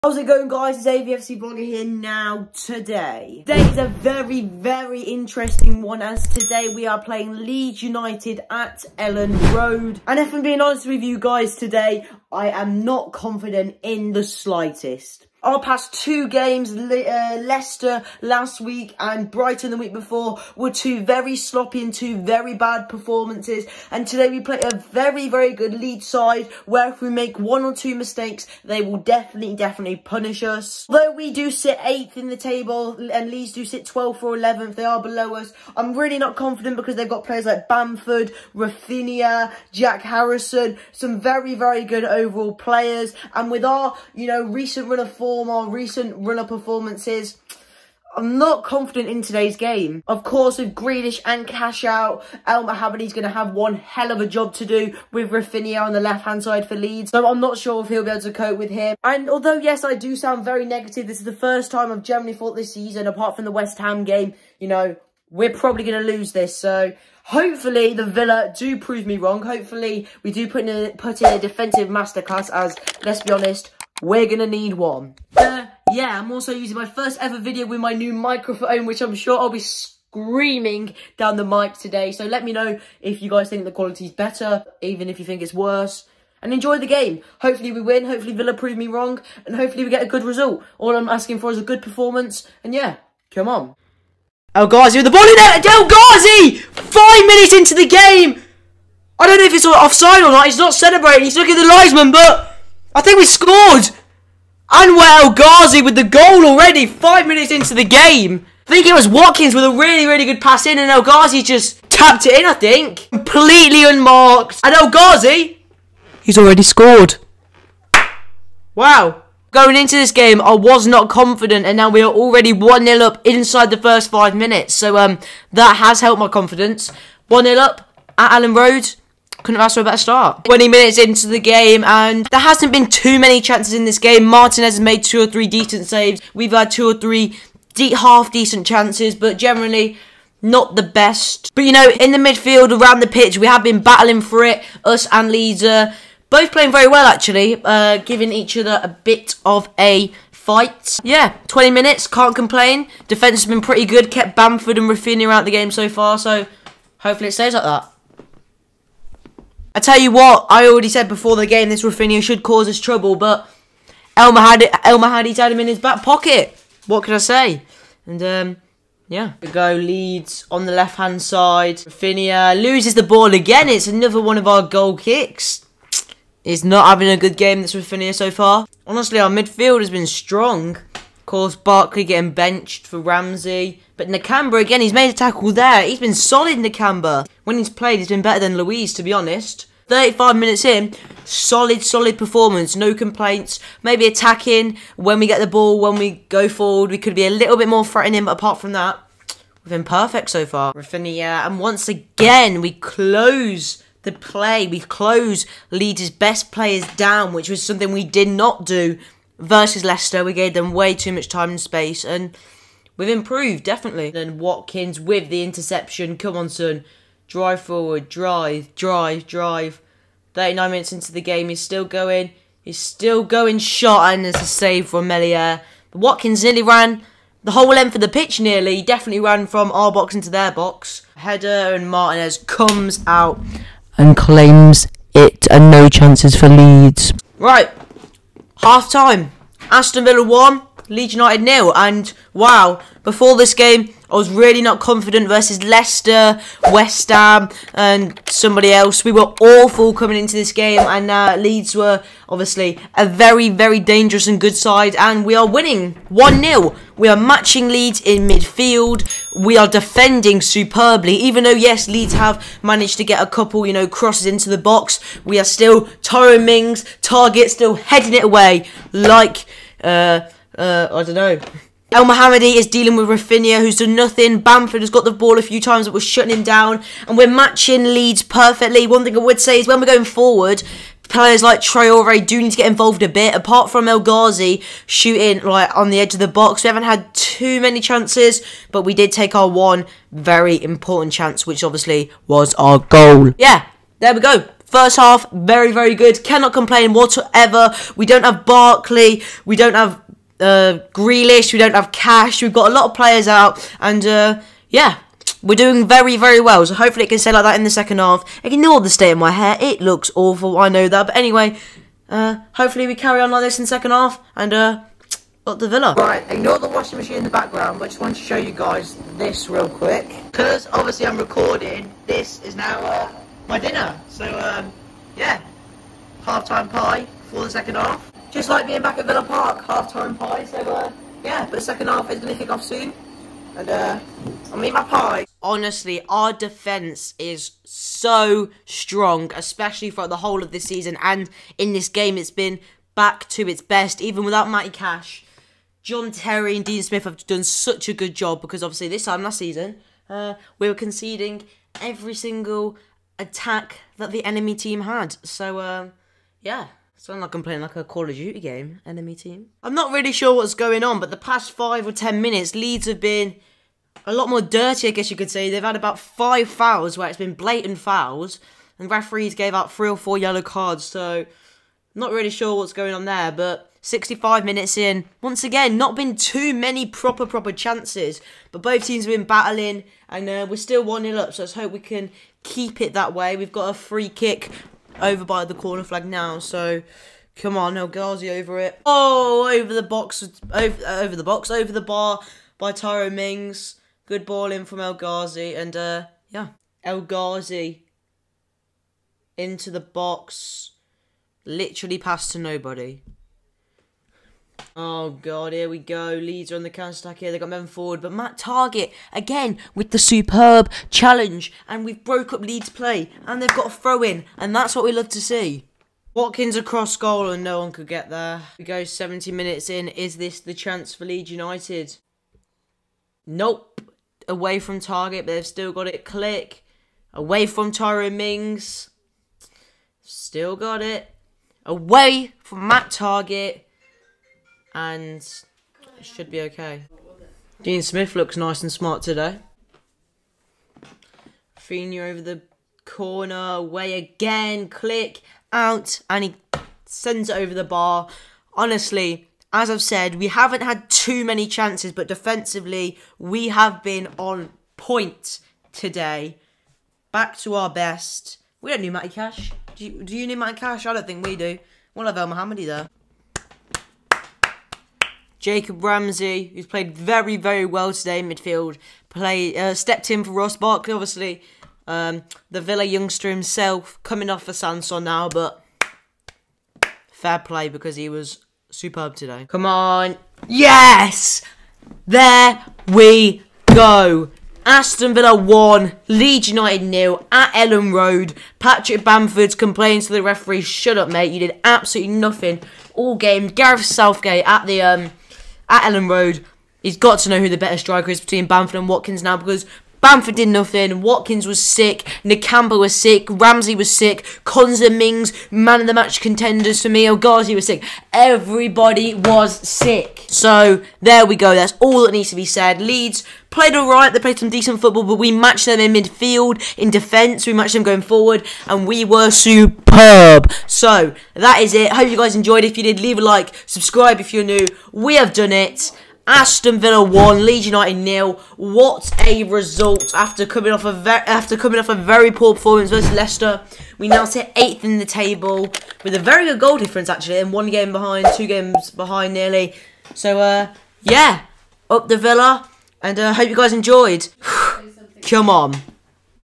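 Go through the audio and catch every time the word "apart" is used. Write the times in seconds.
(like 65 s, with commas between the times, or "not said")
63 s, 198 s, 283 s.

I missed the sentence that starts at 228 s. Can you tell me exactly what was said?
He definitely ran from our box into their box.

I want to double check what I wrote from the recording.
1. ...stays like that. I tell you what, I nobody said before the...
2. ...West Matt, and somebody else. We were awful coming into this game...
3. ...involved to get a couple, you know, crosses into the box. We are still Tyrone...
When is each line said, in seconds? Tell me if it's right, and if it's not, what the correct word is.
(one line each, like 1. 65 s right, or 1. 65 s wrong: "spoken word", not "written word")
1. 157 s wrong: "already", not "nobody"
2. 246 s wrong: "Ham", not "Matt"
3. 262 s wrong: "managed", not "involved".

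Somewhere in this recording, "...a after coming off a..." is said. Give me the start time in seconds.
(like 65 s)
530 s.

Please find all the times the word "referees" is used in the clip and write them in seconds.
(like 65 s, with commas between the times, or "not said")
368 s, 490 s.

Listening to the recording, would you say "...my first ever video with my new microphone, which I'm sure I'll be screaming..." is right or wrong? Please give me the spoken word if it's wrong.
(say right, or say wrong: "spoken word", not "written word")
right.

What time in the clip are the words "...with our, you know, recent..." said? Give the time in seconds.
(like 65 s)
43 s.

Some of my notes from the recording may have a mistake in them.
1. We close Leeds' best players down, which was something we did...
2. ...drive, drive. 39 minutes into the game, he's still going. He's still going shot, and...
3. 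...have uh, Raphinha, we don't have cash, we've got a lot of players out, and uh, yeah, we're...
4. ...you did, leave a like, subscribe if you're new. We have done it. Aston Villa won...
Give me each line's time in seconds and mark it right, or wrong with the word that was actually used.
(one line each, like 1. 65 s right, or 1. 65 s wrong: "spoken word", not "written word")
1. 204 s right
2. 218 s right
3. 299 s wrong: "Grealish", not "Raphinha"
4. 522 s right.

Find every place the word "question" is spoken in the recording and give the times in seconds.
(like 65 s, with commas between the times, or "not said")
not said.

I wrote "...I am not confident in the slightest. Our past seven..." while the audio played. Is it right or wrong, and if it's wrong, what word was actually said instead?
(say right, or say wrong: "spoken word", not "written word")
wrong: "two", not "seven".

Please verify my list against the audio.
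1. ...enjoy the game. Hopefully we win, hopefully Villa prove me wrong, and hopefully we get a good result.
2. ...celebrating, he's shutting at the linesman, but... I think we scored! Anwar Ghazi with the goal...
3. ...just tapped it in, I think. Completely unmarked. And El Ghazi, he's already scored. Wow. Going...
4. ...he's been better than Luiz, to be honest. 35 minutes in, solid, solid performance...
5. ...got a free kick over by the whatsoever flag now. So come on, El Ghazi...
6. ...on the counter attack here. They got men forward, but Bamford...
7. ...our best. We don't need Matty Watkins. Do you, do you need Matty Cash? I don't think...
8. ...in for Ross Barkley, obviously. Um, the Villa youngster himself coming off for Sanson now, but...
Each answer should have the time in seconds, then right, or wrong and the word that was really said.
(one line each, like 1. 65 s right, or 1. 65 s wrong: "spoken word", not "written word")
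1. 86 s right
2. 100 s wrong: "looking", not "shutting"
3. 111 s right
4. 187 s right
5. 383 s wrong: "corner", not "whatsoever"
6. 406 s wrong: "Matt", not "Bamford"
7. 457 s wrong: "Cash", not "Watkins"
8. 470 s right.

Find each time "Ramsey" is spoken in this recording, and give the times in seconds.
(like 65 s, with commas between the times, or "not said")
182 s, 465 s, 503 s.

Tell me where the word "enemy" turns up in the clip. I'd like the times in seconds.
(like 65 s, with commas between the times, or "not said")
354 s, 358 s.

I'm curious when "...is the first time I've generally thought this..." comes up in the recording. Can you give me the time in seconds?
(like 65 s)
61 s.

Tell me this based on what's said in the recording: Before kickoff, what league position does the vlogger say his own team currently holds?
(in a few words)
8th.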